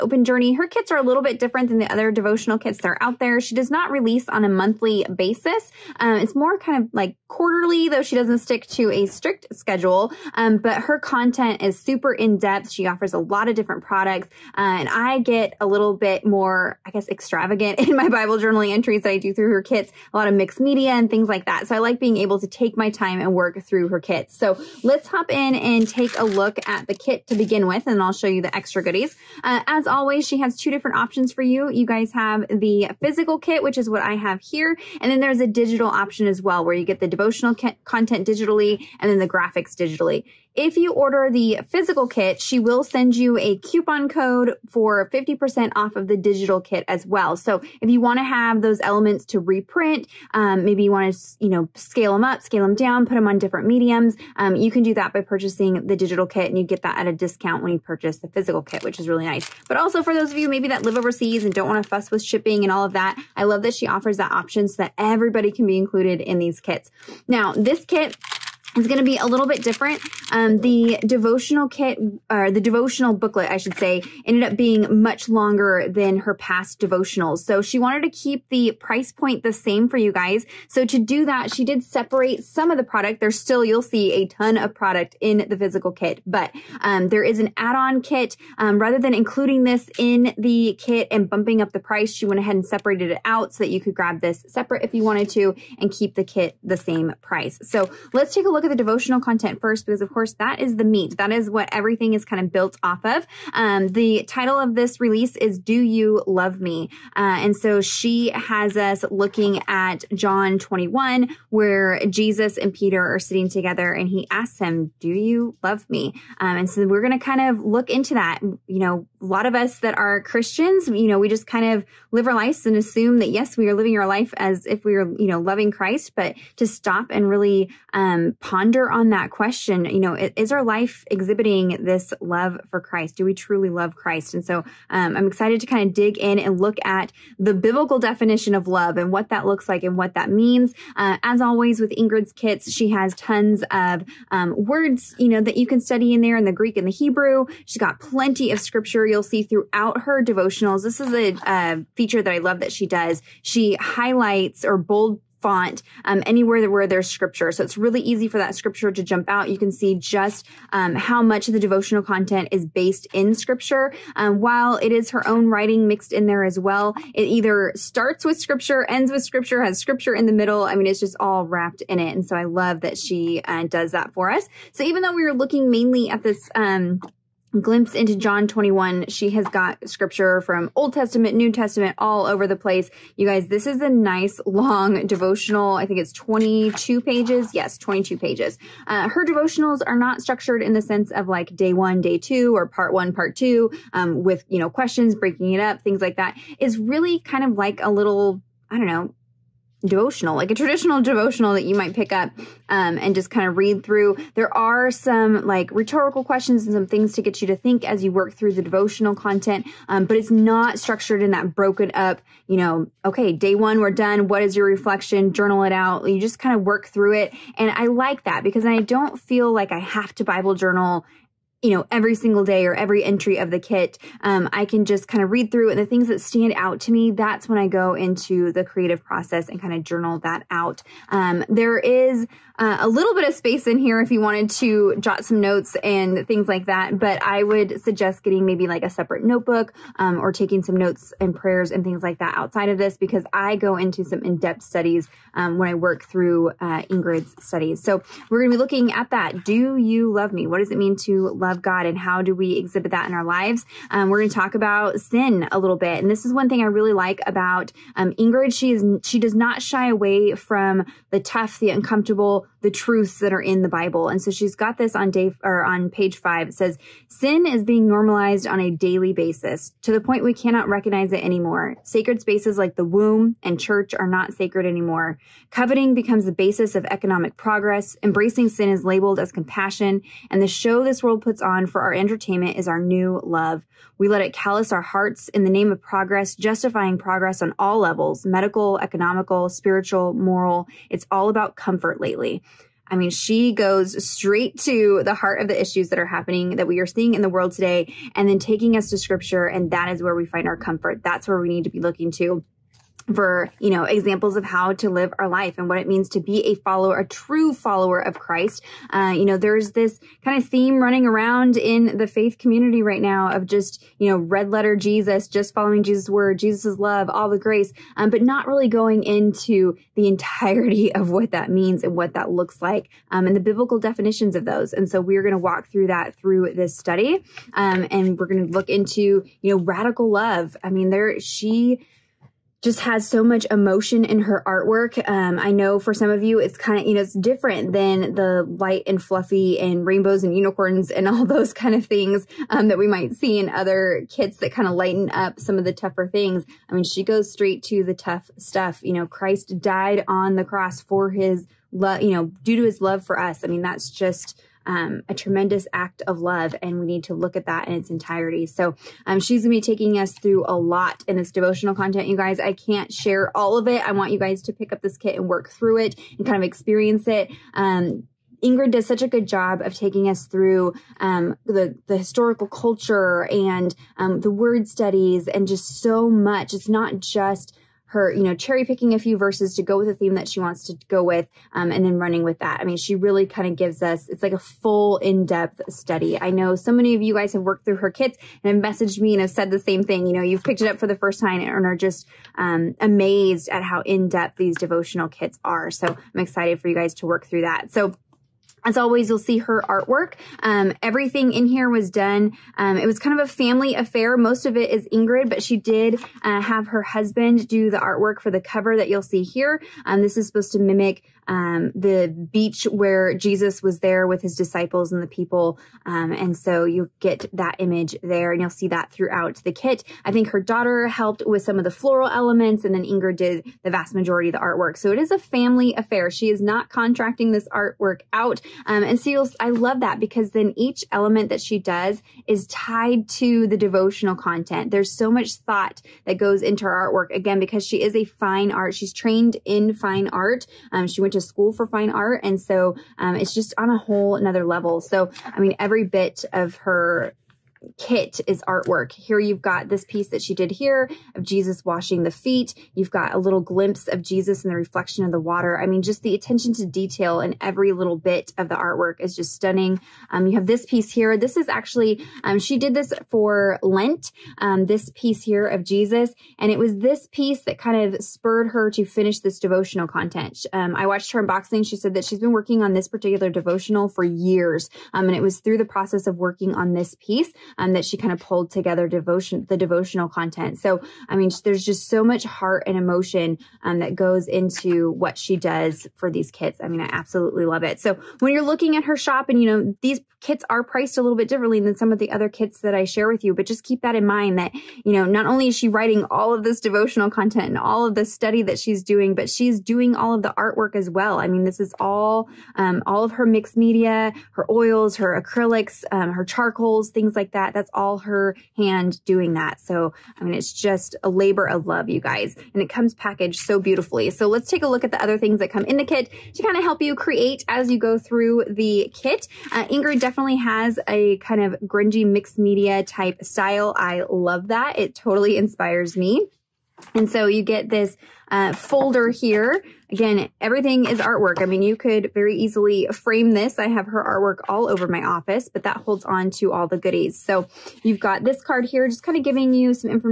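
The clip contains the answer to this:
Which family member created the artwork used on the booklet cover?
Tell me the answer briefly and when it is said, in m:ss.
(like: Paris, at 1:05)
Her husband, at 6:46.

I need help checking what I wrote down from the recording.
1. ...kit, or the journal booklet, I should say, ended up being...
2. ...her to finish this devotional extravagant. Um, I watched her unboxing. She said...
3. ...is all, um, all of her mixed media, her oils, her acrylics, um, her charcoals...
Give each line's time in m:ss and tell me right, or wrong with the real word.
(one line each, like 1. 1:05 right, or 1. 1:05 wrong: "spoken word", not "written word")
1. 1:11 wrong: "devotional", not "journal"
2. 7:48 wrong: "content", not "extravagant"
3. 8:21 right.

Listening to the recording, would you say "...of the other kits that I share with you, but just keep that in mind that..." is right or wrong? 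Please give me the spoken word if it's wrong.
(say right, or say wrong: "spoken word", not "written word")
right.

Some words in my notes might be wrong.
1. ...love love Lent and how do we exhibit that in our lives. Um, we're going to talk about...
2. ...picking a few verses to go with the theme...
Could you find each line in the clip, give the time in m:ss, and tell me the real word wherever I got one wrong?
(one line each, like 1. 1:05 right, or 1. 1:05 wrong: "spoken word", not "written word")
1. 4:11 wrong: "God", not "Lent"
2. 6:18 right.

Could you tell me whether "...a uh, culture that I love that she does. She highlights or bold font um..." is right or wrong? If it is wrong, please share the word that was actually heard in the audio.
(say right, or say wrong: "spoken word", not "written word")
wrong: "feature", not "culture".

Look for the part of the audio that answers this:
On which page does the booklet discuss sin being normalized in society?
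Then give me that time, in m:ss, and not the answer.
4:25.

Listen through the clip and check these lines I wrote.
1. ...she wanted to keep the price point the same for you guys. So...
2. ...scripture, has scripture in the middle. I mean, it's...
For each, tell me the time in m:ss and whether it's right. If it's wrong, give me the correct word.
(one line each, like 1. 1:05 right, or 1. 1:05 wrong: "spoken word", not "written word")
1. 1:17 right
2. 2:49 right.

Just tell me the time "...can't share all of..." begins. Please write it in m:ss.
6:02.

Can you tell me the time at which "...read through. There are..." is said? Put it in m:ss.
3:23.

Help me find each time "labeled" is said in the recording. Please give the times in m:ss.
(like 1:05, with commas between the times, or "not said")
4:38.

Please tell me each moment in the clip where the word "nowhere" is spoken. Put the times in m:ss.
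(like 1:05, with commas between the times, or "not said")
not said.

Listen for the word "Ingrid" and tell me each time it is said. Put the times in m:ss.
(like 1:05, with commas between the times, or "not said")
2:21, 4:06, 4:18, 6:08, 6:44, 7:02, 8:39.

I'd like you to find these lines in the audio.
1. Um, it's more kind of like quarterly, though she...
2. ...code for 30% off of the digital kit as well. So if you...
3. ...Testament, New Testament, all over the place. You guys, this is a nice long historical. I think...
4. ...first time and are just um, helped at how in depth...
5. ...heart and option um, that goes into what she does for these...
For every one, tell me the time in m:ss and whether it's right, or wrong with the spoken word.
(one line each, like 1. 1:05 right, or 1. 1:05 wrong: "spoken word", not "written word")
1. 0:05 right
2. 0:44 wrong: "50", not "30"
3. 3:00 wrong: "devotional", not "historical"
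4. 6:30 wrong: "amazed", not "helped"
5. 8:02 wrong: "emotion", not "option".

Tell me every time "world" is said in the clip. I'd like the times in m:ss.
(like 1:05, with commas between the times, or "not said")
4:41, 4:57.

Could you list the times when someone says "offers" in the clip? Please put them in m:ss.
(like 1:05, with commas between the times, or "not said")
0:12, 1:03.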